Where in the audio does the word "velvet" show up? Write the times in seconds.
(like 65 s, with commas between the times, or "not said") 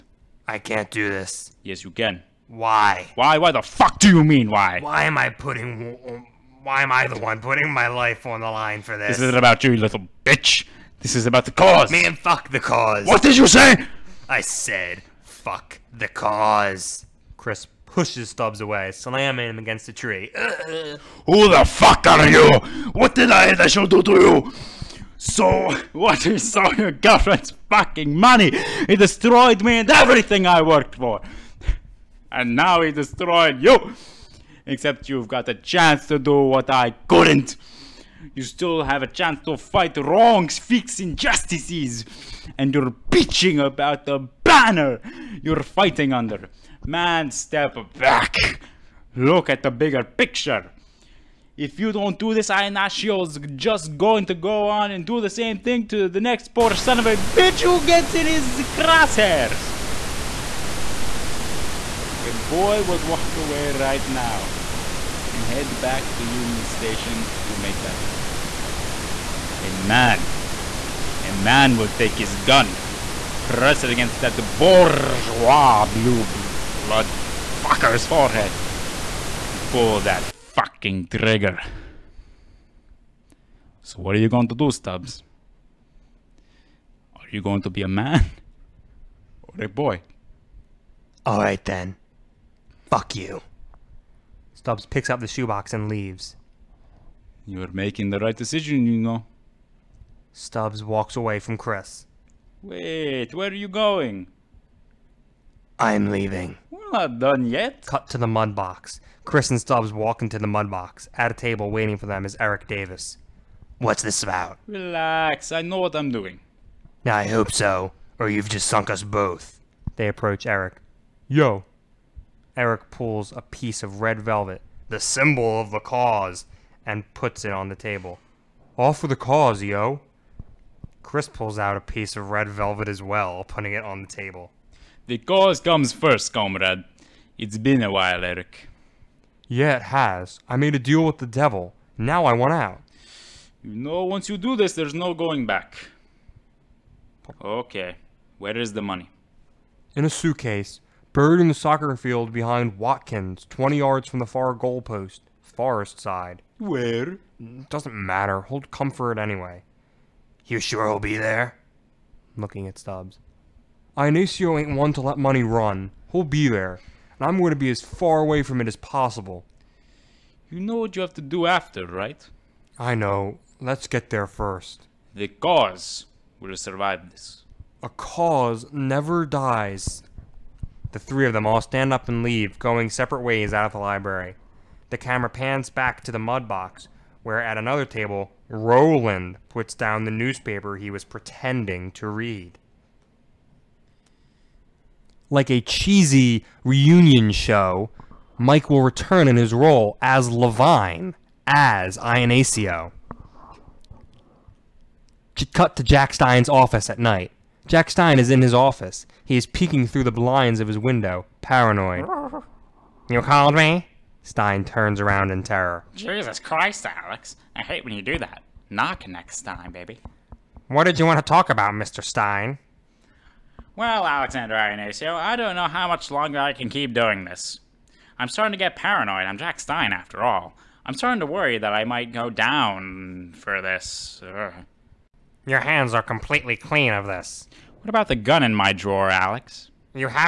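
124 s, 132 s.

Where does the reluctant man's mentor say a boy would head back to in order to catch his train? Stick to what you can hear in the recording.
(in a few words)
Union Station.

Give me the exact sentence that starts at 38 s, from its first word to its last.
You still have a chance to fight wrongs, fix injustices.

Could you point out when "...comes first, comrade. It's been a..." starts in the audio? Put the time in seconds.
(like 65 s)
135 s.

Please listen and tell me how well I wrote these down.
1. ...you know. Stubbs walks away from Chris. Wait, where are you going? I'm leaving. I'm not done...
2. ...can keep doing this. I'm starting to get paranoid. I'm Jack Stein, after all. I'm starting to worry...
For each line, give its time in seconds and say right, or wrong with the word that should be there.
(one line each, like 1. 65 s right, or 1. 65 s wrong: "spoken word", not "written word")
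1. 98 s right
2. 226 s right.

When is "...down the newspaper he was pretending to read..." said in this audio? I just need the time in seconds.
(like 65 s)
189 s.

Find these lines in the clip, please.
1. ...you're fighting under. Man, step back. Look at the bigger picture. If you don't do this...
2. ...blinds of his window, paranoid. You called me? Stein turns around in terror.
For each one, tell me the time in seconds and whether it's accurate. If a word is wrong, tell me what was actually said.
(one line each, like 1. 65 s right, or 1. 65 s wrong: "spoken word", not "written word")
1. 45 s right
2. 210 s right.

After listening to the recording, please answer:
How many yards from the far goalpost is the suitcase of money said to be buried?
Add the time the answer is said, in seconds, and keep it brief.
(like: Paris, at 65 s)
20, at 153 s.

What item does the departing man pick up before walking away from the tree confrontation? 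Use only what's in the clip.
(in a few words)
the shoebox.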